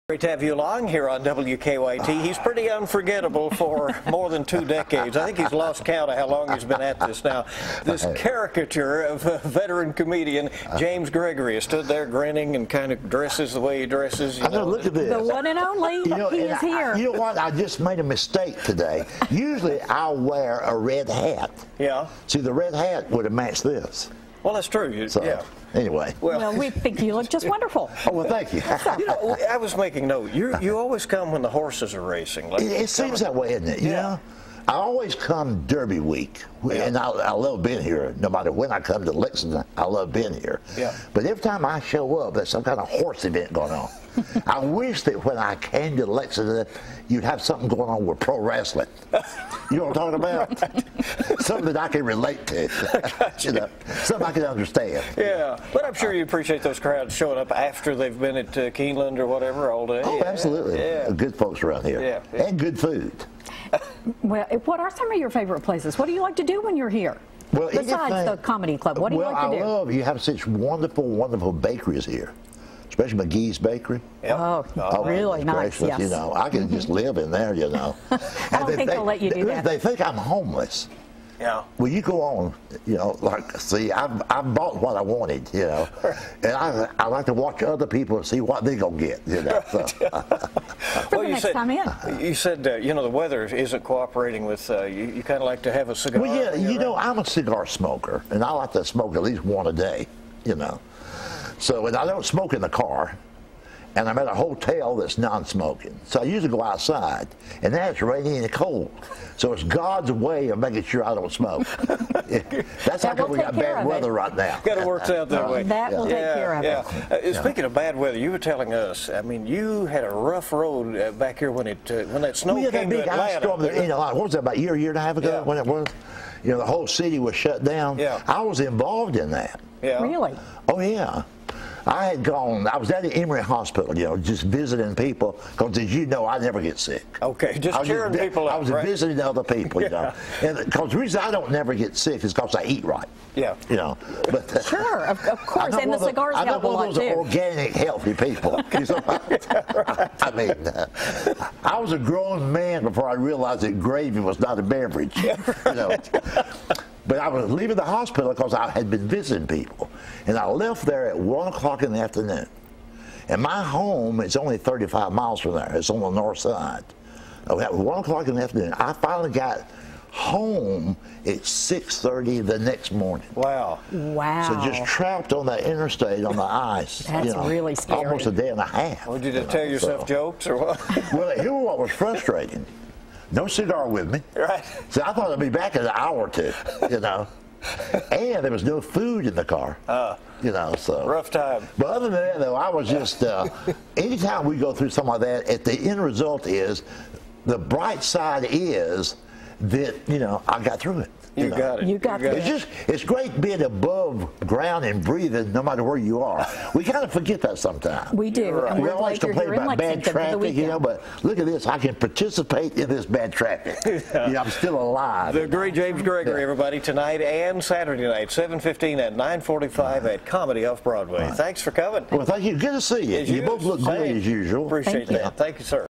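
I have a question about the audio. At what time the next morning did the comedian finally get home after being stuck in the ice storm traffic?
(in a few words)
6:30.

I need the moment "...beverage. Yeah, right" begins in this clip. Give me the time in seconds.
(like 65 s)
154 s.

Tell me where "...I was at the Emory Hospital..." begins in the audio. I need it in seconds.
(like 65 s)
132 s.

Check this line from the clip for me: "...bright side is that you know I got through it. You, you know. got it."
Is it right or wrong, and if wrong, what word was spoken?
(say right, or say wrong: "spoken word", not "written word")
right.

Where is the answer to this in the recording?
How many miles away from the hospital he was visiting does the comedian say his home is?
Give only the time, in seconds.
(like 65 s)
164 s.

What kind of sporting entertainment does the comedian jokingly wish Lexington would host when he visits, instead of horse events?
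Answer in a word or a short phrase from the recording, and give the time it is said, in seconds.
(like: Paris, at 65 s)
Pro wrestling, at 48 s.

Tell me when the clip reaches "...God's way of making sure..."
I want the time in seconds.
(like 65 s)
109 s.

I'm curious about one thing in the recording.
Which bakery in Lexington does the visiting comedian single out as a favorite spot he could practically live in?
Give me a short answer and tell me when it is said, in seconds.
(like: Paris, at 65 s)
Magee's Bakery, at 73 s.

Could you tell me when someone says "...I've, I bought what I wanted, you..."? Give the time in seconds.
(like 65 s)
83 s.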